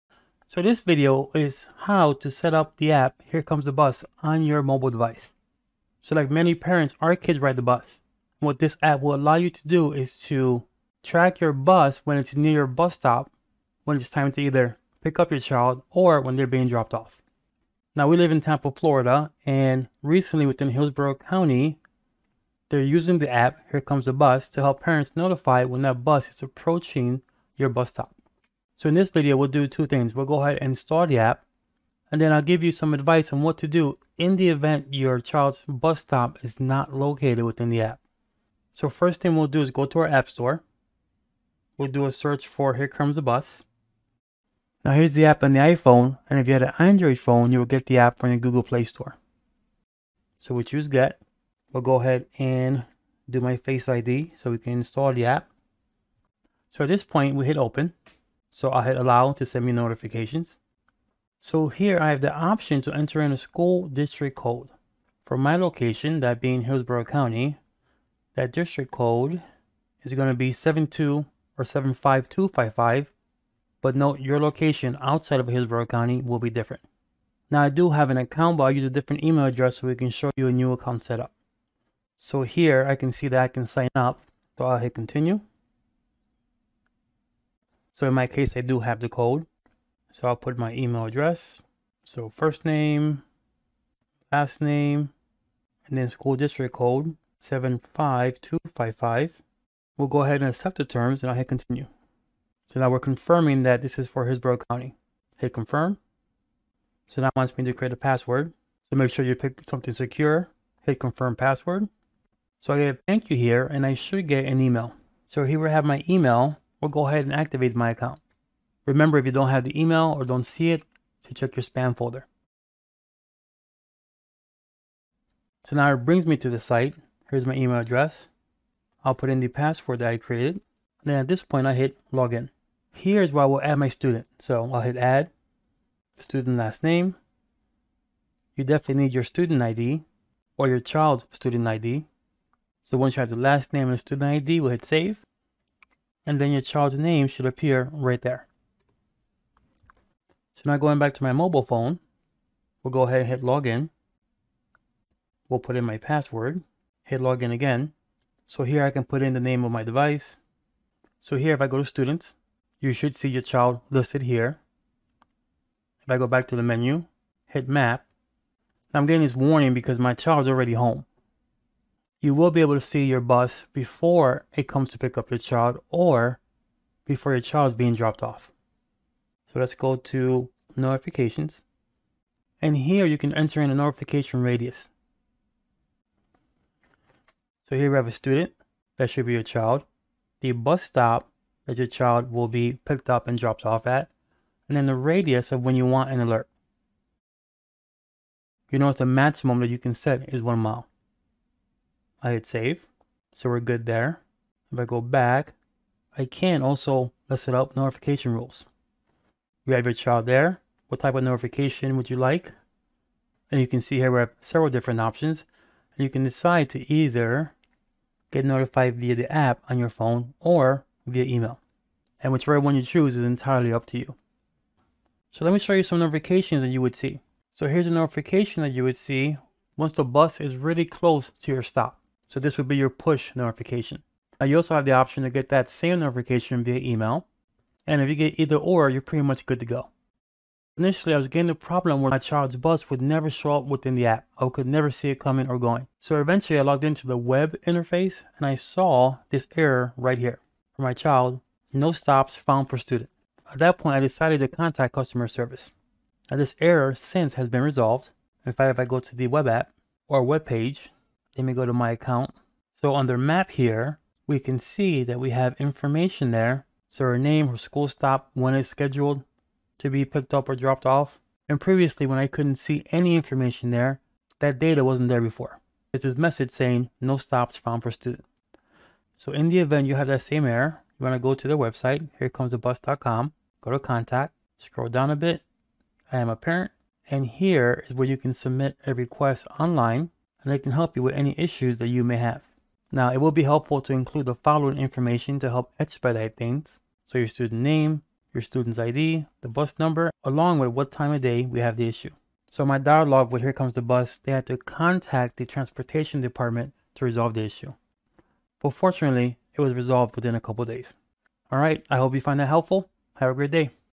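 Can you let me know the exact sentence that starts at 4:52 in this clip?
Now, it will be helpful to include the following information to help expedite things.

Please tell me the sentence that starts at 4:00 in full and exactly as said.
Initially, I was getting a problem where my child's bus would never show up within the app.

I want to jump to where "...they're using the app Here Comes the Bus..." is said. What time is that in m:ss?
0:22.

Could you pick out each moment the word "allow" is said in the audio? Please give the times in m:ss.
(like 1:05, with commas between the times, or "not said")
0:09, 0:58.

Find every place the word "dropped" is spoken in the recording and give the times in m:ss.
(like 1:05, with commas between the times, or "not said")
0:16, 2:57, 3:13, 4:30.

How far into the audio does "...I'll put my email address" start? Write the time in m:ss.
1:30.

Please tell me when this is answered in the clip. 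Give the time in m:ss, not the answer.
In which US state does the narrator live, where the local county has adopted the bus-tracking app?
0:18.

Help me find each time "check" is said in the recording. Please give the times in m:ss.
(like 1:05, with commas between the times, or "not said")
2:01.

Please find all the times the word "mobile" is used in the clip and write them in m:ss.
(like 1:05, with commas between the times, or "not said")
0:04, 2:31.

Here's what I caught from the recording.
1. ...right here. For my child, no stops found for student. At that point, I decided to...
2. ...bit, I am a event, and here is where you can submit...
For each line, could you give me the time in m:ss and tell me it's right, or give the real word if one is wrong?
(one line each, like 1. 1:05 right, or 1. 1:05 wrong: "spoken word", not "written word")
1. 4:09 right
2. 4:45 wrong: "parent", not "event".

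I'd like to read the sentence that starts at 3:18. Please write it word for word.
You notice the maximum that you can set is one mile.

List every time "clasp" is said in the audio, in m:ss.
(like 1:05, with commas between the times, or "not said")
not said.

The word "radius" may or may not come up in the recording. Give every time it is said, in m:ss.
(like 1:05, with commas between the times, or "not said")
3:04, 3:14.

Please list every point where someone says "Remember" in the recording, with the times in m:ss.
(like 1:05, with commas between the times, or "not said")
1:58.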